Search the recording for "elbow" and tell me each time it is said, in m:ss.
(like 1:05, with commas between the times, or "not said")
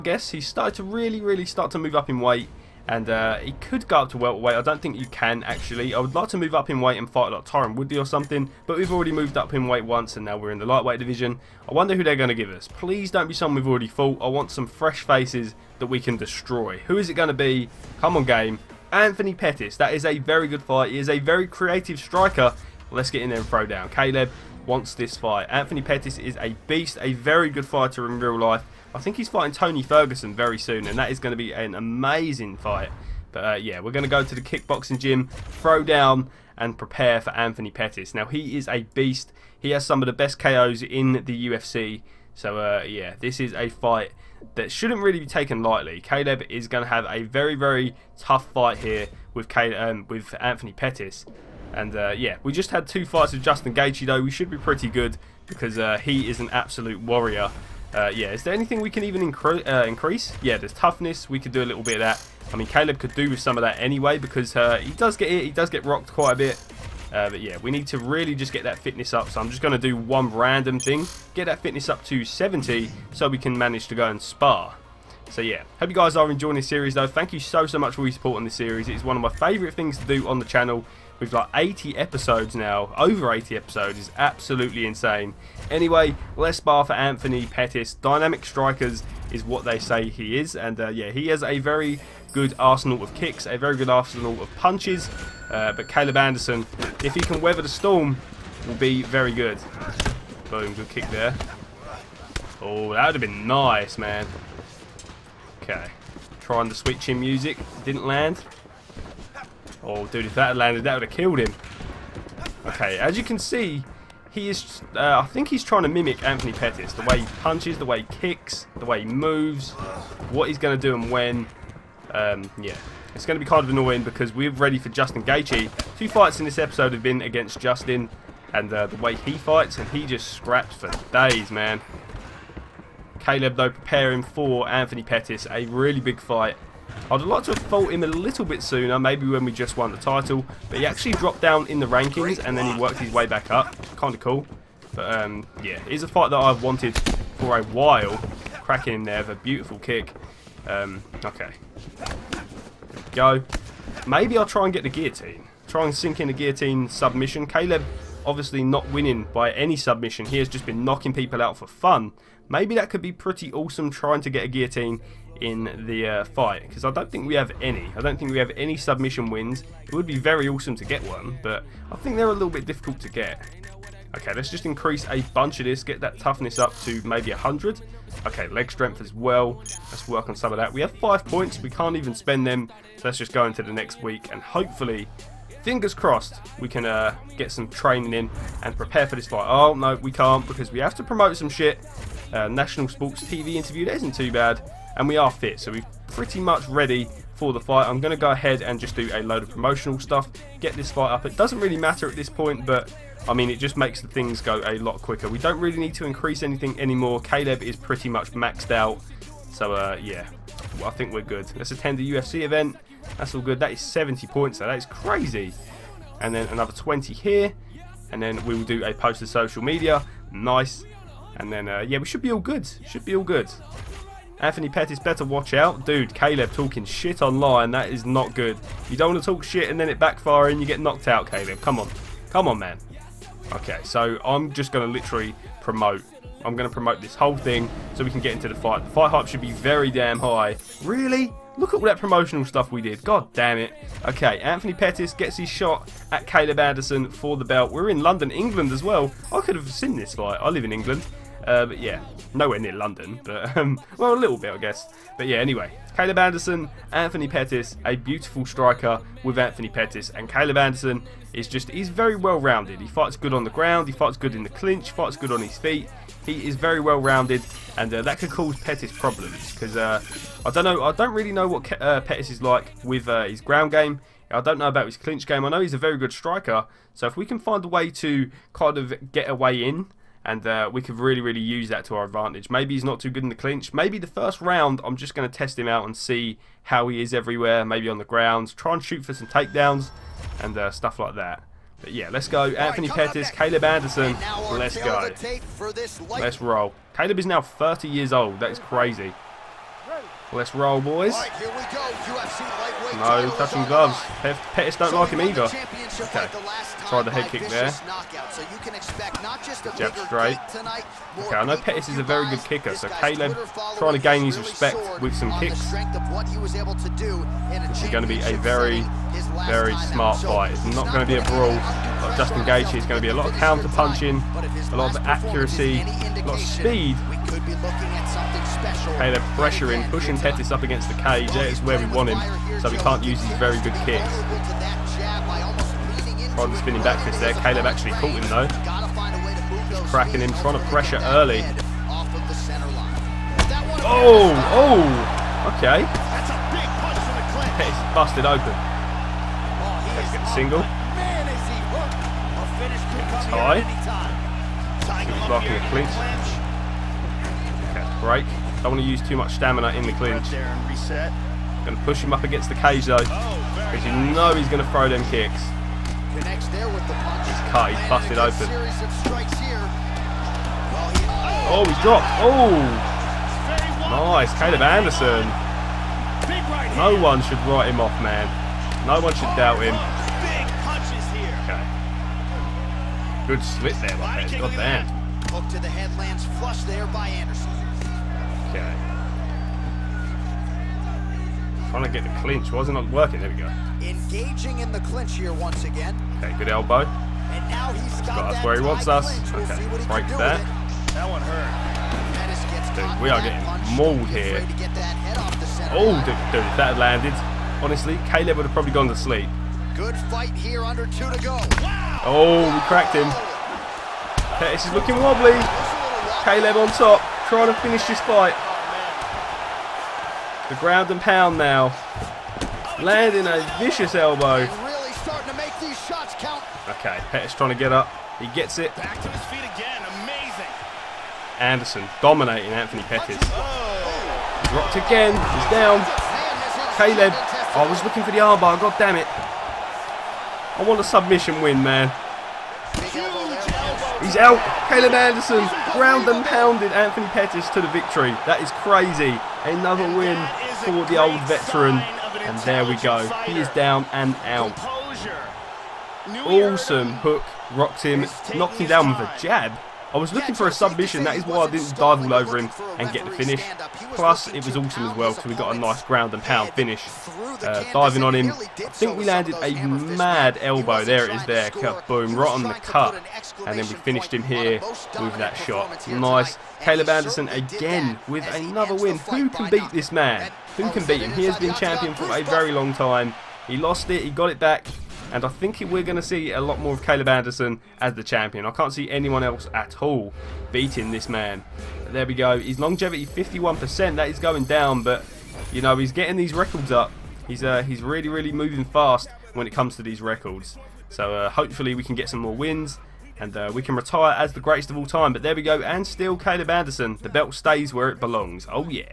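6:36, 7:03, 7:50.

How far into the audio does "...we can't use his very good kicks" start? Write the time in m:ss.
5:32.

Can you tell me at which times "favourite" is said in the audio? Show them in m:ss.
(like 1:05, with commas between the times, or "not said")
1:19.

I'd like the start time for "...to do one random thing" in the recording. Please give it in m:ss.
1:09.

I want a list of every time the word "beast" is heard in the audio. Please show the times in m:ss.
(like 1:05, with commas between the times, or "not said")
0:26, 0:38.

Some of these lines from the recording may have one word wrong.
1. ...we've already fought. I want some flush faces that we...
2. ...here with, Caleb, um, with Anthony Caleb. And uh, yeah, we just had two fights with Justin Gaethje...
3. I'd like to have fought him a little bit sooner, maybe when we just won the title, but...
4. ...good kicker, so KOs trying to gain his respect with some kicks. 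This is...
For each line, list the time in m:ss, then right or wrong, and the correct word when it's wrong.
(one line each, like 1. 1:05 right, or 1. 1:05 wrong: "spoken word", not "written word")
1. 0:13 wrong: "fresh", not "flush"
2. 0:48 wrong: "Pettis", not "Caleb"
3. 2:17 right
4. 5:12 wrong: "Caleb", not "KOs".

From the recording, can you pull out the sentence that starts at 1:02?
I mean, Caleb could do with some of that anyway because uh, he does get hit.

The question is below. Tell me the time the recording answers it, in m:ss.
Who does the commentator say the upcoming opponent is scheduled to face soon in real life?
0:29.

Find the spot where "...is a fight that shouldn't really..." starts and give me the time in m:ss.
0:43.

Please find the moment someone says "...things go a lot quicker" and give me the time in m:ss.
3:24.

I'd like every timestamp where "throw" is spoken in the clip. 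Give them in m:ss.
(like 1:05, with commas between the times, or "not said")
0:23, 0:35, 6:04.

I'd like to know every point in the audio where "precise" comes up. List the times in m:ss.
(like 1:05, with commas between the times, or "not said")
not said.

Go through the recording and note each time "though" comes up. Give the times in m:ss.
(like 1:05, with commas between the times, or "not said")
0:54, 1:16, 2:13, 5:38, 6:02.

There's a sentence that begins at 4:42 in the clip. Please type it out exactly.
Maybe he's not too good in the clinch.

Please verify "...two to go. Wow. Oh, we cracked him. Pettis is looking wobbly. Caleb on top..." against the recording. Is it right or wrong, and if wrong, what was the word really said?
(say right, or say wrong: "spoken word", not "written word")
right.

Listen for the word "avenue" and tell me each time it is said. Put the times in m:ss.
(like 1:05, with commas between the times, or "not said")
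not said.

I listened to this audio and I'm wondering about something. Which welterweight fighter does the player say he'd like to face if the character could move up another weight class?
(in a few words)
Tyron Woodley.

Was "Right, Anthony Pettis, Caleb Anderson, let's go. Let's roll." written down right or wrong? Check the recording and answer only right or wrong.
right.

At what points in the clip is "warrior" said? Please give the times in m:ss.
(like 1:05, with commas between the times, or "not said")
0:57.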